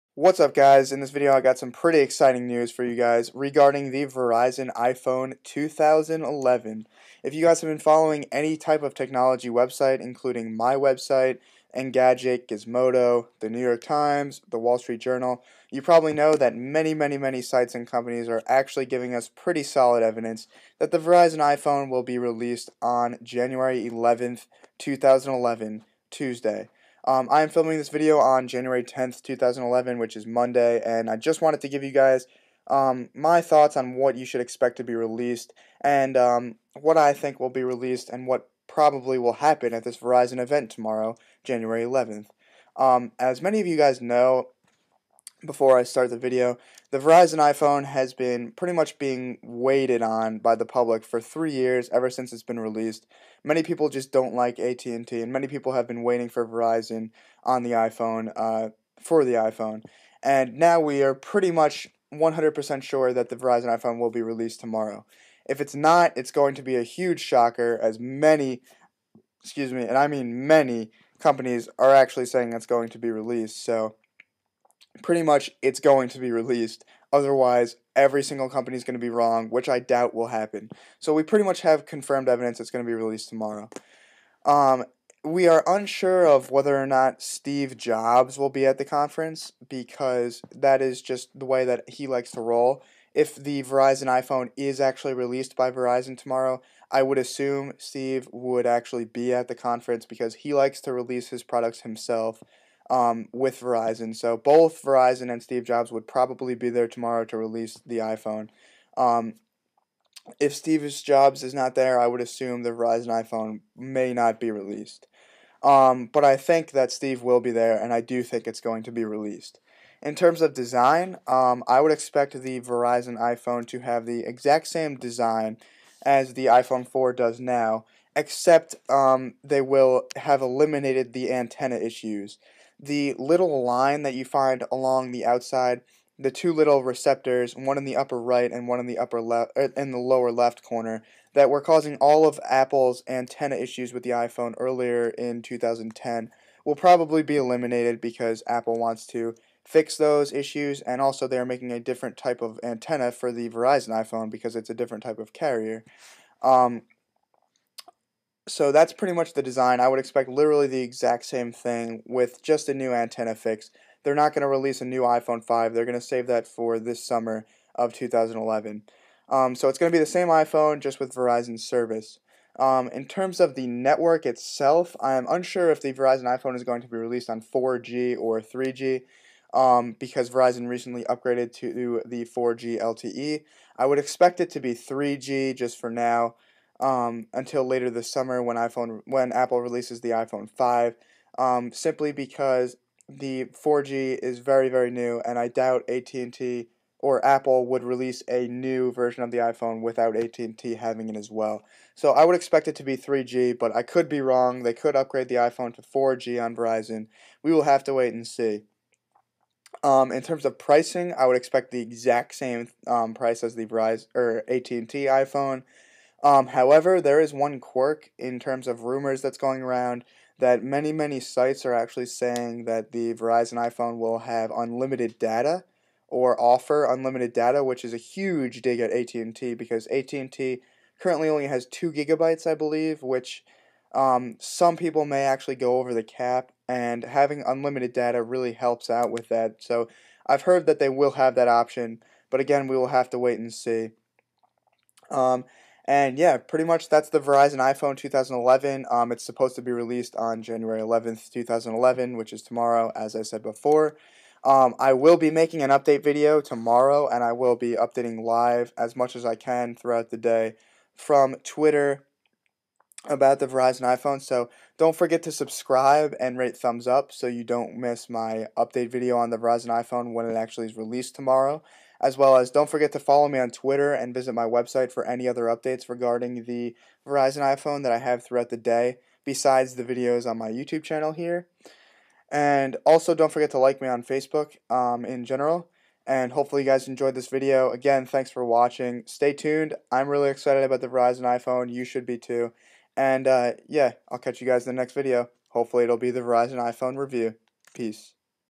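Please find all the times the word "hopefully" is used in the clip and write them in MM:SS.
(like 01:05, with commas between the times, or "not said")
04:46, 04:55.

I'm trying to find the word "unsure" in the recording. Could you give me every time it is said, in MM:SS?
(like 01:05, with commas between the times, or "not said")
01:25, 02:55.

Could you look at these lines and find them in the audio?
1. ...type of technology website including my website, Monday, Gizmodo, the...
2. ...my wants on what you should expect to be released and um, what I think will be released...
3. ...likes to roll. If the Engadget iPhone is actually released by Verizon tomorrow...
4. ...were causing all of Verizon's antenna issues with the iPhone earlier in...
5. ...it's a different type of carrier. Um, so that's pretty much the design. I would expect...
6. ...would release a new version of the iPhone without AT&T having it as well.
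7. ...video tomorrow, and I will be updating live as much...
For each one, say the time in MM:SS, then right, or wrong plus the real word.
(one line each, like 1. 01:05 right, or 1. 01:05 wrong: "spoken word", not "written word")
1. 00:08 wrong: "Engadget", not "Monday"
2. 00:33 wrong: "thoughts", not "wants"
3. 01:32 wrong: "Verizon", not "Engadget"
4. 02:21 wrong: "Apple", not "Verizon"
5. 02:34 right
6. 03:17 right
7. 04:16 right.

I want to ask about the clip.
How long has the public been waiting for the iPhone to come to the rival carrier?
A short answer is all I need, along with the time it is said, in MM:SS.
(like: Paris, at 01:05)
3 years, at 00:51.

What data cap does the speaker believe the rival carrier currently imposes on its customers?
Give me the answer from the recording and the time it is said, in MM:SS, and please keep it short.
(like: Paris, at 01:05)
2 gigabytes, at 03:51.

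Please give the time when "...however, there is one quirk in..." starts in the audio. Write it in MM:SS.
03:36.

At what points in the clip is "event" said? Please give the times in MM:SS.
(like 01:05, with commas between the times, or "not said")
00:40.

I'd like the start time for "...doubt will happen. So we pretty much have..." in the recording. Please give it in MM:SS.
01:19.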